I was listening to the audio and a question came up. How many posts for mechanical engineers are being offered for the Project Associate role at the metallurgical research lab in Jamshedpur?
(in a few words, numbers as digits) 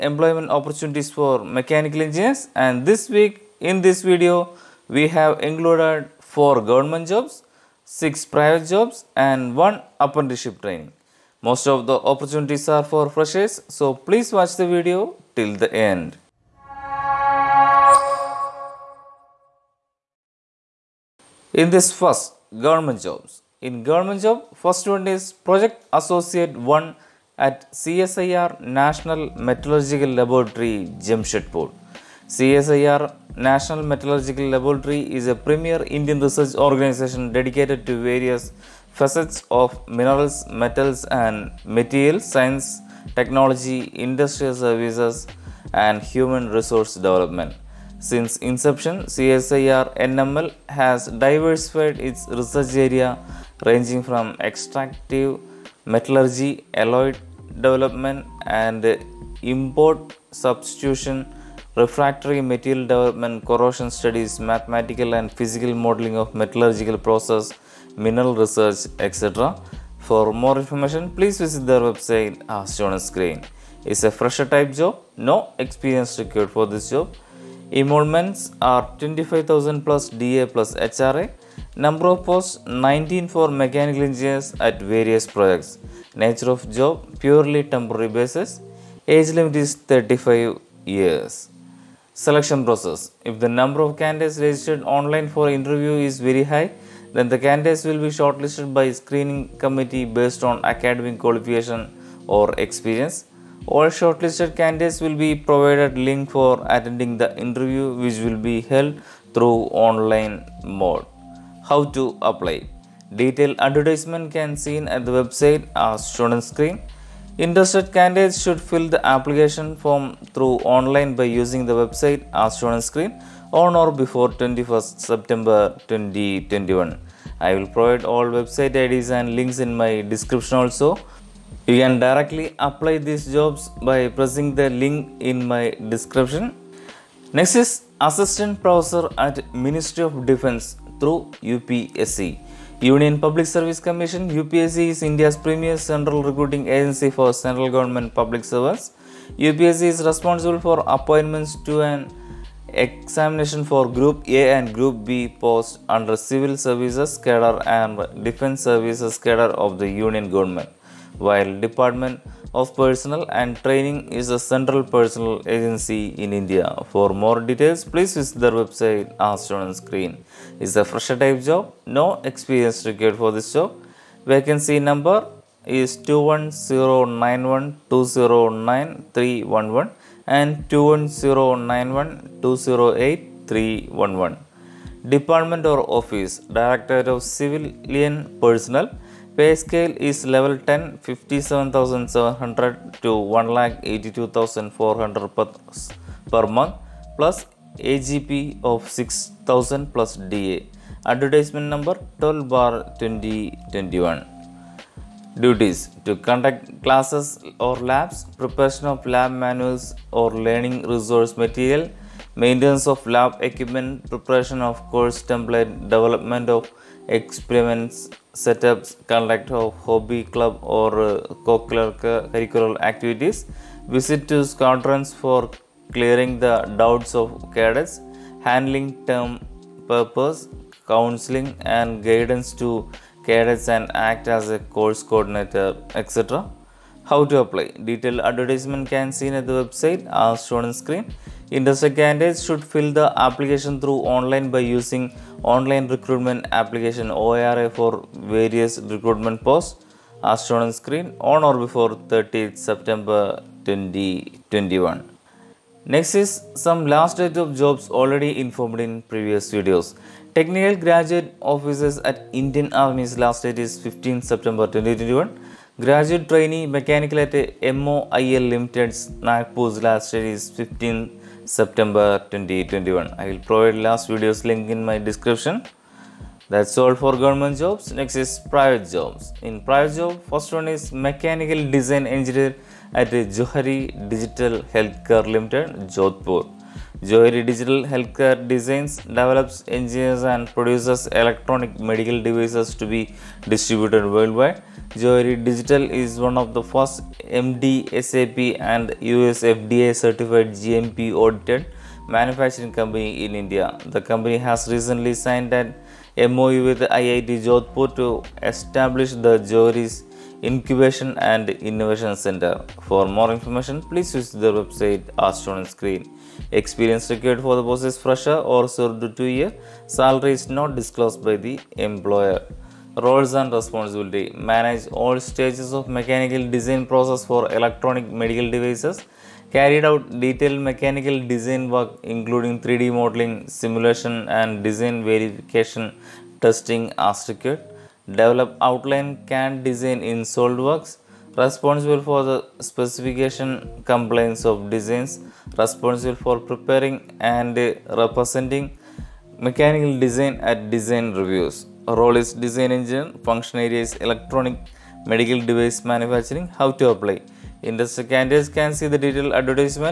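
19.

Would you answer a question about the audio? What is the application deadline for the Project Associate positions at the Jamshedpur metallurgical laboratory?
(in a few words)
21st September 2021.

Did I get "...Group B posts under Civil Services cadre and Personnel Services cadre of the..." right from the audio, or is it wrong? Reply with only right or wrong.
wrong.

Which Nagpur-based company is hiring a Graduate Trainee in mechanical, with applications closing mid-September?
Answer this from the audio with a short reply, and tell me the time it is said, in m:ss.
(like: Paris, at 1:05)
MOIL Limited, at 4:27.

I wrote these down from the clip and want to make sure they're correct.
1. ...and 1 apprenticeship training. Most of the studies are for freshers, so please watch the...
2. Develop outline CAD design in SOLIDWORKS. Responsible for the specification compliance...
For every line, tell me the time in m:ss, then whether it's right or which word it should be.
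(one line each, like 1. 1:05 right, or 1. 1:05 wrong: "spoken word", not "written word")
1. 0:09 wrong: "opportunities", not "studies"
2. 5:38 right.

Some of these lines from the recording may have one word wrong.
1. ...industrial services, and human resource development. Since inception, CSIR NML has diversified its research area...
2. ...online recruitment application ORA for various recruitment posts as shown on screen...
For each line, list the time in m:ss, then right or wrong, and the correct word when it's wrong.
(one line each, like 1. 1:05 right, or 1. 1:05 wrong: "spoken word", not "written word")
1. 0:43 right
2. 4:05 right.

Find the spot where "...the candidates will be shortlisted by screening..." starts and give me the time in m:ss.
1:37.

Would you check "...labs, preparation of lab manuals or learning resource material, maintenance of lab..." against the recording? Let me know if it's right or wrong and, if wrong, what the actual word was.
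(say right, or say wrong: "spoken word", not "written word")
right.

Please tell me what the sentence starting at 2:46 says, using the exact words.
For more details, please visit their website as shown on screen is a fresher type job.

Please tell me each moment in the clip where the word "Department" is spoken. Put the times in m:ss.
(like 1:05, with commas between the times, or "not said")
2:41, 3:05.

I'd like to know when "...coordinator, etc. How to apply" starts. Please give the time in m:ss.
3:55.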